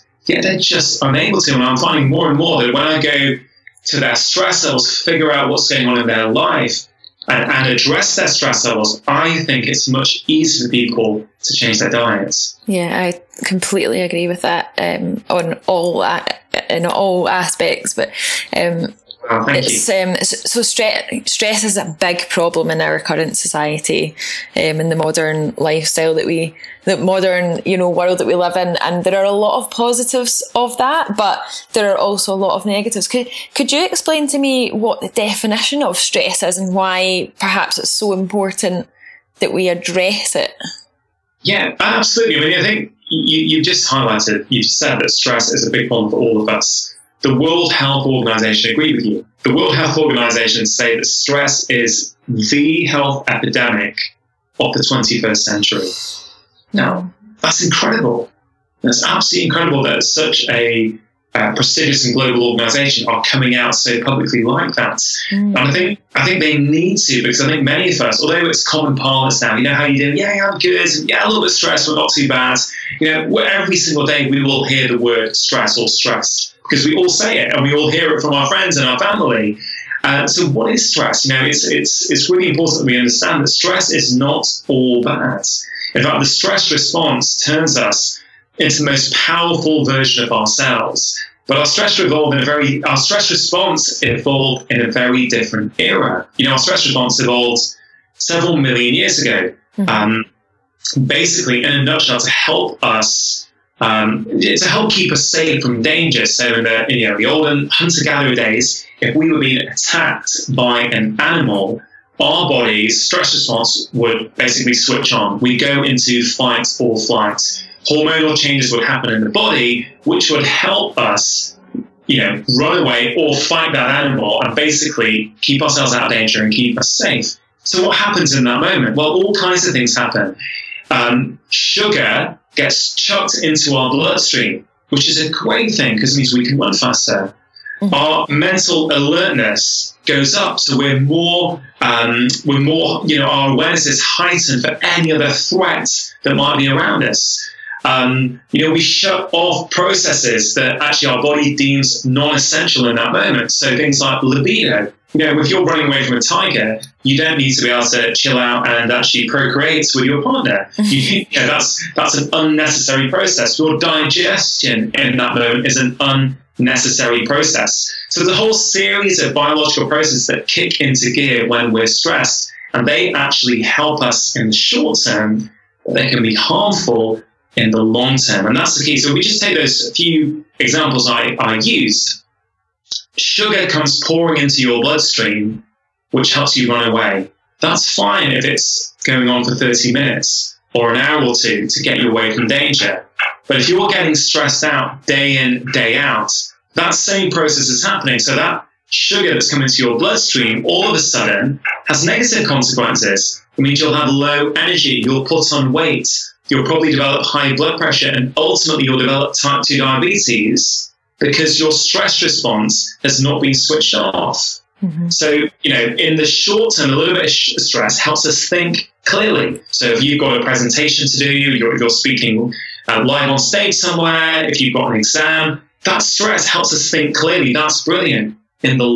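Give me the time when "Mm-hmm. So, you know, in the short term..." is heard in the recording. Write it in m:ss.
3:34.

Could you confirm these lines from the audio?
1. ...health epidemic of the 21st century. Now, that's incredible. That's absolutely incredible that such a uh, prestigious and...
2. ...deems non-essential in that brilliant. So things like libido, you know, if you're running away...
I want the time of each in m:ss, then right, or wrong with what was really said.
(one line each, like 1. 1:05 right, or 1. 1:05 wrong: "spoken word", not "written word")
1. 0:52 right
2. 2:31 wrong: "moment", not "brilliant".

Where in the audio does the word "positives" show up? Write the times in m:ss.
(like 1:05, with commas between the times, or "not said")
0:29.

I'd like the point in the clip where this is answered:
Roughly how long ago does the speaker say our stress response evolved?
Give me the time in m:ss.
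1:38.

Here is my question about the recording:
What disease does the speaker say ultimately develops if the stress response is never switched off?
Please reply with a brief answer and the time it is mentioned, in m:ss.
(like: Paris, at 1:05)
type 2 diabetes, at 3:29.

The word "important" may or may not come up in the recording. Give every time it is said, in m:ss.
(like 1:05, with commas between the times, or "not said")
0:38, 1:22.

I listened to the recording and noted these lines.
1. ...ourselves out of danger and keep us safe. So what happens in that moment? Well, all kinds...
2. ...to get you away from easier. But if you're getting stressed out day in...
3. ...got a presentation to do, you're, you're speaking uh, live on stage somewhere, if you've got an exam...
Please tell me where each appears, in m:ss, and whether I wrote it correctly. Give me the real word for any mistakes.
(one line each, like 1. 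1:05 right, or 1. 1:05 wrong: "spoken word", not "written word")
1. 2:05 right
2. 3:11 wrong: "danger", not "easier"
3. 3:40 right.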